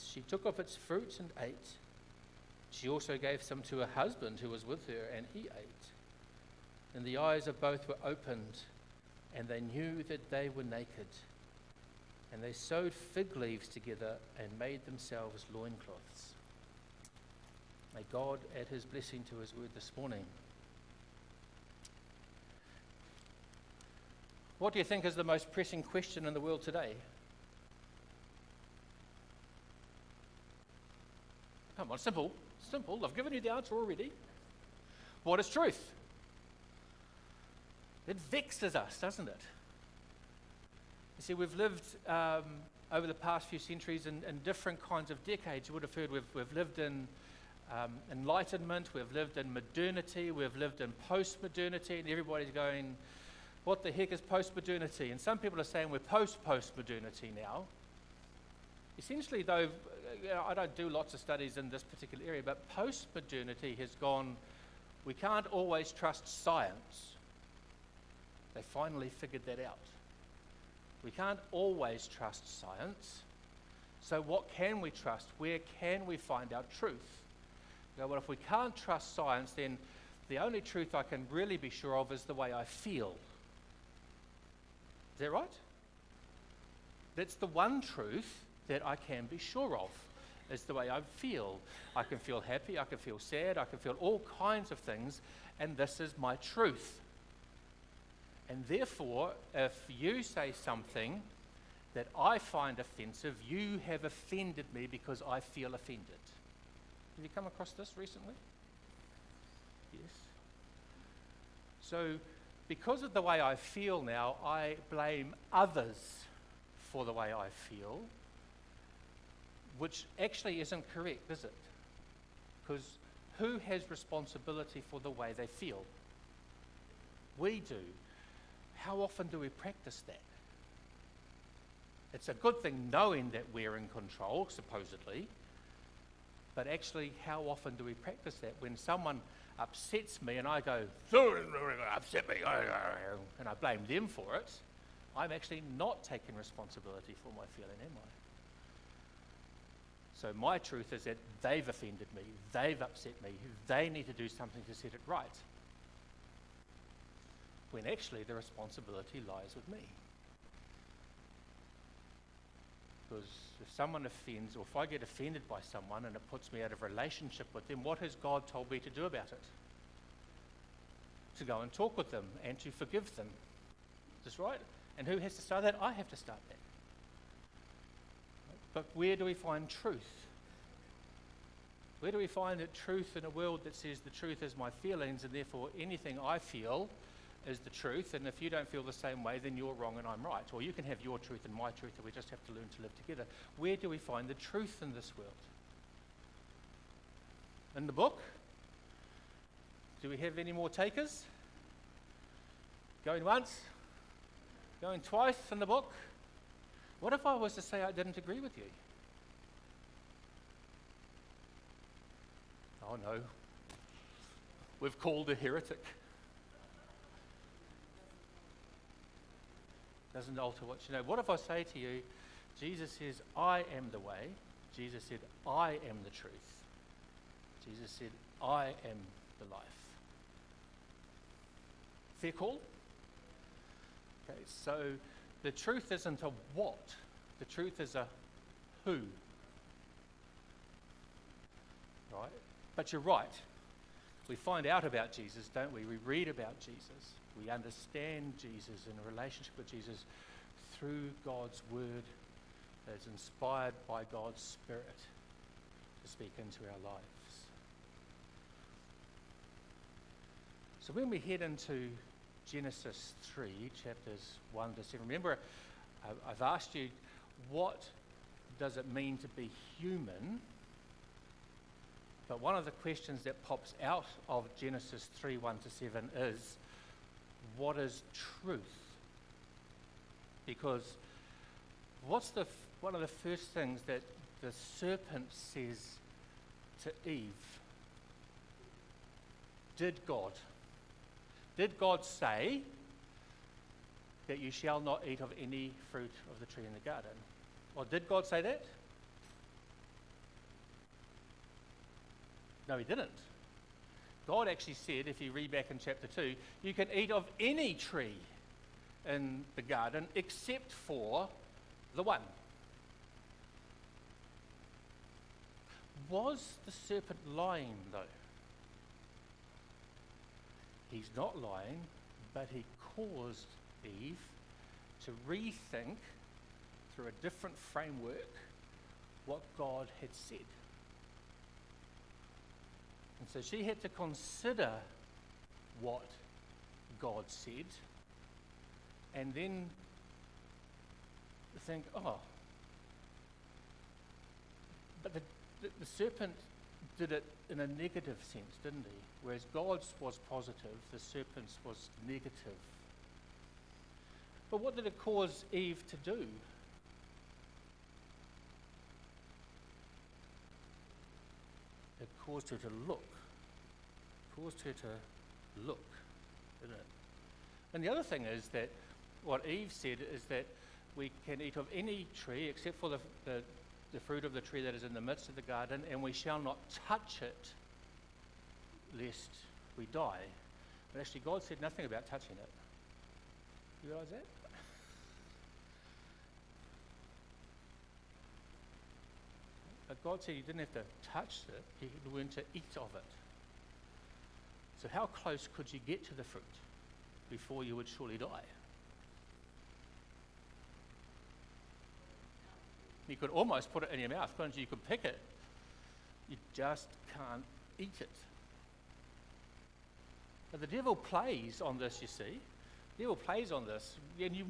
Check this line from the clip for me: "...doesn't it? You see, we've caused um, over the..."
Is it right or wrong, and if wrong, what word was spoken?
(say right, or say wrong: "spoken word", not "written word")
wrong: "lived", not "caused".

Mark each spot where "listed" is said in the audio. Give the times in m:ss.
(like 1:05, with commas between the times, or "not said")
not said.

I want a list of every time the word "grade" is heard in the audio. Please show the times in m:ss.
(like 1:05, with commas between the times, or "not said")
not said.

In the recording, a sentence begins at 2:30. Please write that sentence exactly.
So my truth is that they've offended me, they've upset me, they need to do something to set it right.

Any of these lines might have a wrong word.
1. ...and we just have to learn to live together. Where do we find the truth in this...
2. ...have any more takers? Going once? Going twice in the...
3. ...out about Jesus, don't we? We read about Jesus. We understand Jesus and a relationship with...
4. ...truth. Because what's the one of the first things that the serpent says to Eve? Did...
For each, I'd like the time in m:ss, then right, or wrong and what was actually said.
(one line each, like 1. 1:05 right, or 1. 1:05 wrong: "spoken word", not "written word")
1. 3:11 right
2. 3:20 right
3. 4:04 right
4. 4:38 right.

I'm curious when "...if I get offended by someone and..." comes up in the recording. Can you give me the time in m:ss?
2:44.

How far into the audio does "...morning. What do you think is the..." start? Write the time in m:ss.
0:19.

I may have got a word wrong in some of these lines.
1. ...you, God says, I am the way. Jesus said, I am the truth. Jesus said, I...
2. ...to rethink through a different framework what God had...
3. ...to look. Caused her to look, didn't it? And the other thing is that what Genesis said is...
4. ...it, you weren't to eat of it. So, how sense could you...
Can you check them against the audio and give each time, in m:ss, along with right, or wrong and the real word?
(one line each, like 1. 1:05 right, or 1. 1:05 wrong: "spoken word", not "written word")
1. 3:41 wrong: "Jesus", not "God"
2. 5:25 right
3. 6:02 wrong: "Eve", not "Genesis"
4. 6:31 wrong: "close", not "sense".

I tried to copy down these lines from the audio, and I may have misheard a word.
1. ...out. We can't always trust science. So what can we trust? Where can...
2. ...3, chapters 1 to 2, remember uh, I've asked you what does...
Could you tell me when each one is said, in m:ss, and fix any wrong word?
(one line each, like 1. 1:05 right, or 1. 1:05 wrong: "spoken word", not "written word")
1. 1:09 right
2. 4:23 wrong: "7", not "2".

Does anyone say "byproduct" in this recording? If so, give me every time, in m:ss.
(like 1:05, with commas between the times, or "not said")
not said.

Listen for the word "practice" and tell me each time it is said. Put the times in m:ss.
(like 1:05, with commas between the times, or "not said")
2:09, 2:17.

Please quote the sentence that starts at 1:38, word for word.
And therefore, if you say something that I find offensive, you have offended me because I feel offended.